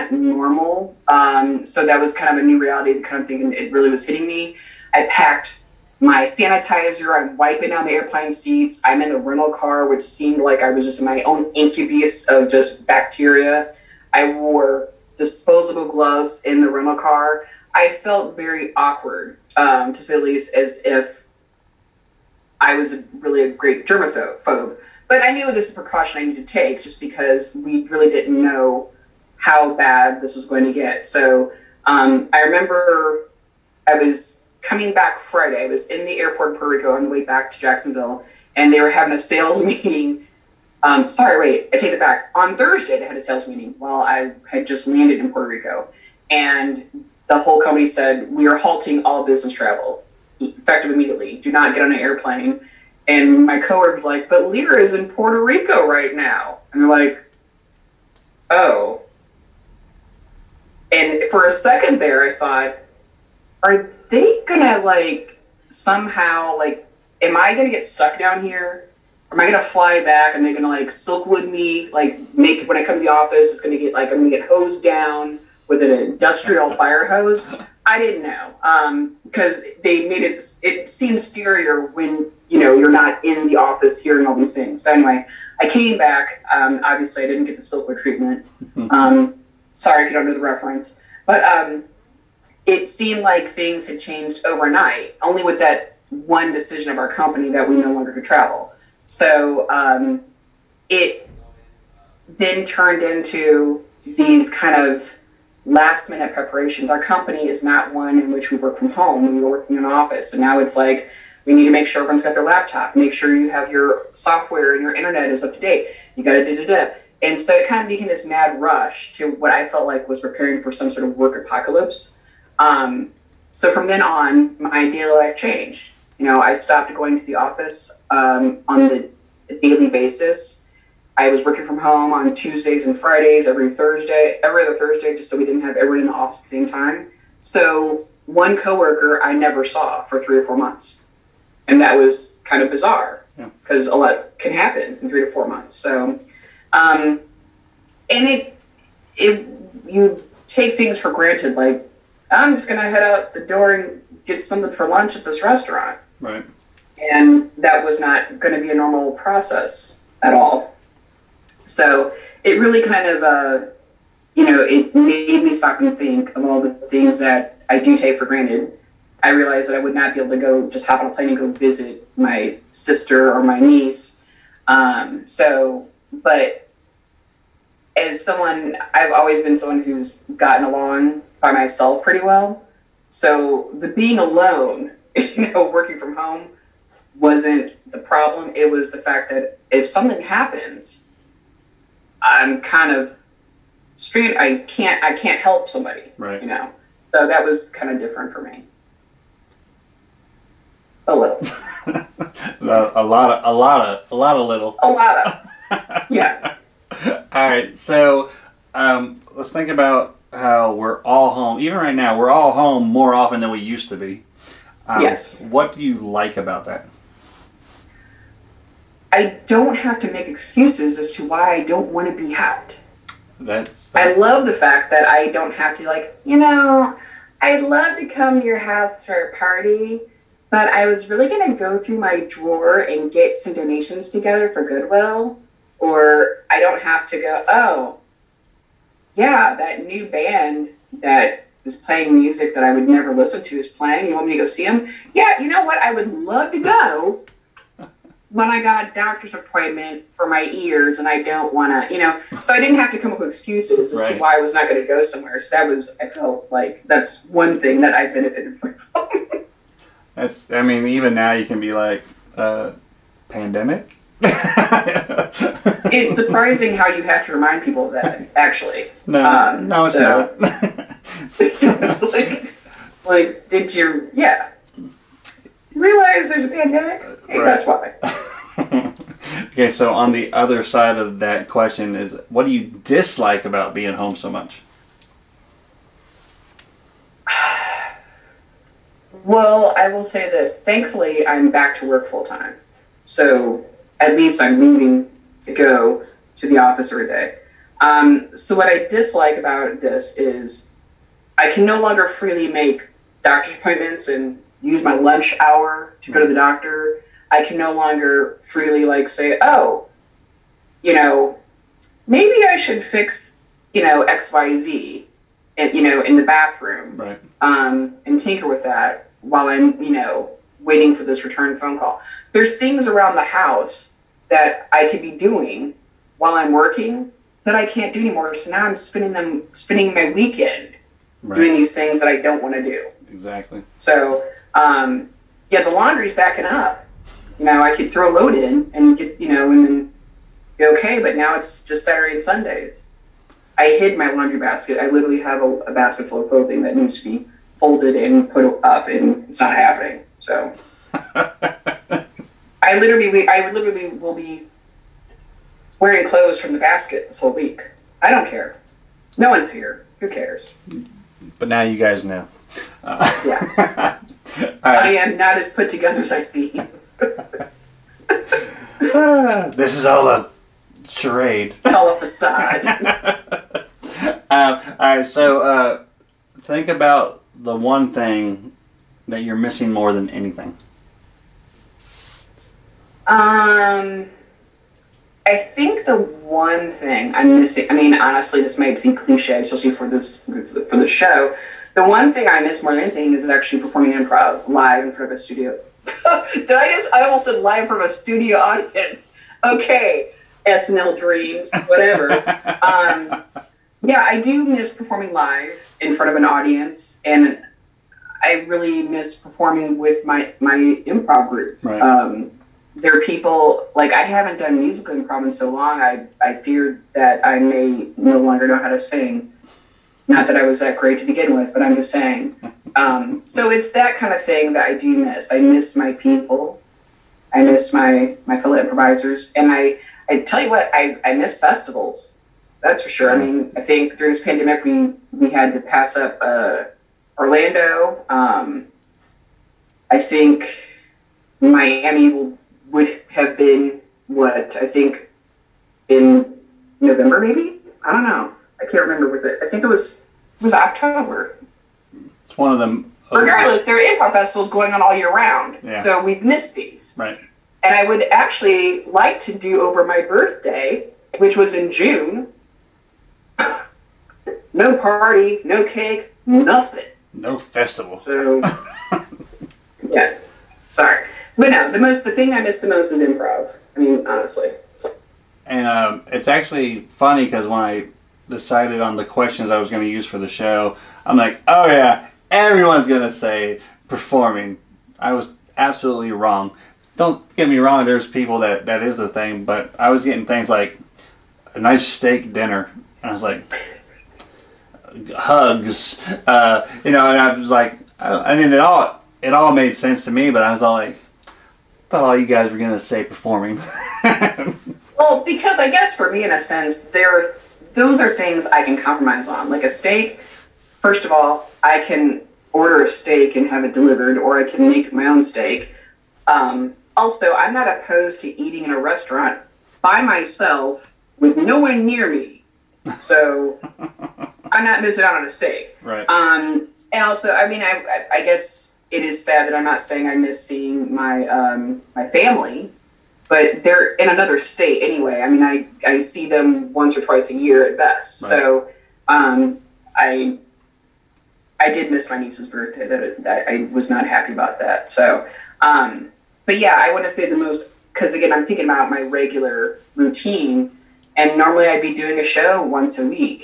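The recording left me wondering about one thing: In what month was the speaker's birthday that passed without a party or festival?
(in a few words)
June.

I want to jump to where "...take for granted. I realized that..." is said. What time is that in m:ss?
2:47.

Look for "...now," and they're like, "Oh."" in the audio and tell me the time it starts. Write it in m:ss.
0:56.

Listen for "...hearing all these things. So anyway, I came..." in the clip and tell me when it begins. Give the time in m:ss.
1:24.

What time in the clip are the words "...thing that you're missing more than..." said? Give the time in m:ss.
6:17.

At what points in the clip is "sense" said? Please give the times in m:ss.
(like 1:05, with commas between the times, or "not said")
8:19, 8:26.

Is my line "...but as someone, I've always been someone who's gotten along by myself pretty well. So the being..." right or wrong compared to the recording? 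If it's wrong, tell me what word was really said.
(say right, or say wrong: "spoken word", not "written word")
right.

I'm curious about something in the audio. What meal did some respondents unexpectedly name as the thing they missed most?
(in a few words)
steak dinner.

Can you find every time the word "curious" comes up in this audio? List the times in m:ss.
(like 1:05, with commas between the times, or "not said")
not said.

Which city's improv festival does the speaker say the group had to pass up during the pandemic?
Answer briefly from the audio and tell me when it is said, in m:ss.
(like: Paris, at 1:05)
Orlando, at 7:17.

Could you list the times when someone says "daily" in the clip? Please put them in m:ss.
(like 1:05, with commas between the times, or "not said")
2:04, 2:09.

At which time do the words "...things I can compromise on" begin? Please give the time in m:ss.
8:28.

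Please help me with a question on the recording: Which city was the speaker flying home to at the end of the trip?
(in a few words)
Jacksonville.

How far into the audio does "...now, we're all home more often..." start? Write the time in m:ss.
3:31.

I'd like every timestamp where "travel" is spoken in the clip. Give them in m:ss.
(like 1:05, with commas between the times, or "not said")
0:49, 1:38.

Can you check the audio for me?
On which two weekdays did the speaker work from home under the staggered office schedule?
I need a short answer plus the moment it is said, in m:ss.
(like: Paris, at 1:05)
Tuesdays and Fridays, at 2:12.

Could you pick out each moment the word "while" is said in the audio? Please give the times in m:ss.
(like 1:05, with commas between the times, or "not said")
0:43, 5:19, 5:26.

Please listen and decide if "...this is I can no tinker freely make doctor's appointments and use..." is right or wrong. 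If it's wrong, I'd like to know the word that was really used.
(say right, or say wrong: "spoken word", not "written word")
wrong: "longer", not "tinker".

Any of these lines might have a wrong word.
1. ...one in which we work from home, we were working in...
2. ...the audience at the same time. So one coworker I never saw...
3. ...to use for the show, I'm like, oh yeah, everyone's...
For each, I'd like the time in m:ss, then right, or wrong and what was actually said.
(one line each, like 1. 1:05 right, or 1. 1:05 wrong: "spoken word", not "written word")
1. 1:47 right
2. 2:16 wrong: "office", not "audience"
3. 7:59 right.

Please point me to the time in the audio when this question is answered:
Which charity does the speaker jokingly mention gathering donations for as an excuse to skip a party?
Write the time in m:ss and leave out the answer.
3:54.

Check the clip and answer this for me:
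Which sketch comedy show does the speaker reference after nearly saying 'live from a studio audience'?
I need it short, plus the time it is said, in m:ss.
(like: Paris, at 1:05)
SNL, at 6:40.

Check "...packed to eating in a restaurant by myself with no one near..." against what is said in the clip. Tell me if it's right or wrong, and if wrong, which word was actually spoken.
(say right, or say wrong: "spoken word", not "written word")
wrong: "opposed", not "packed".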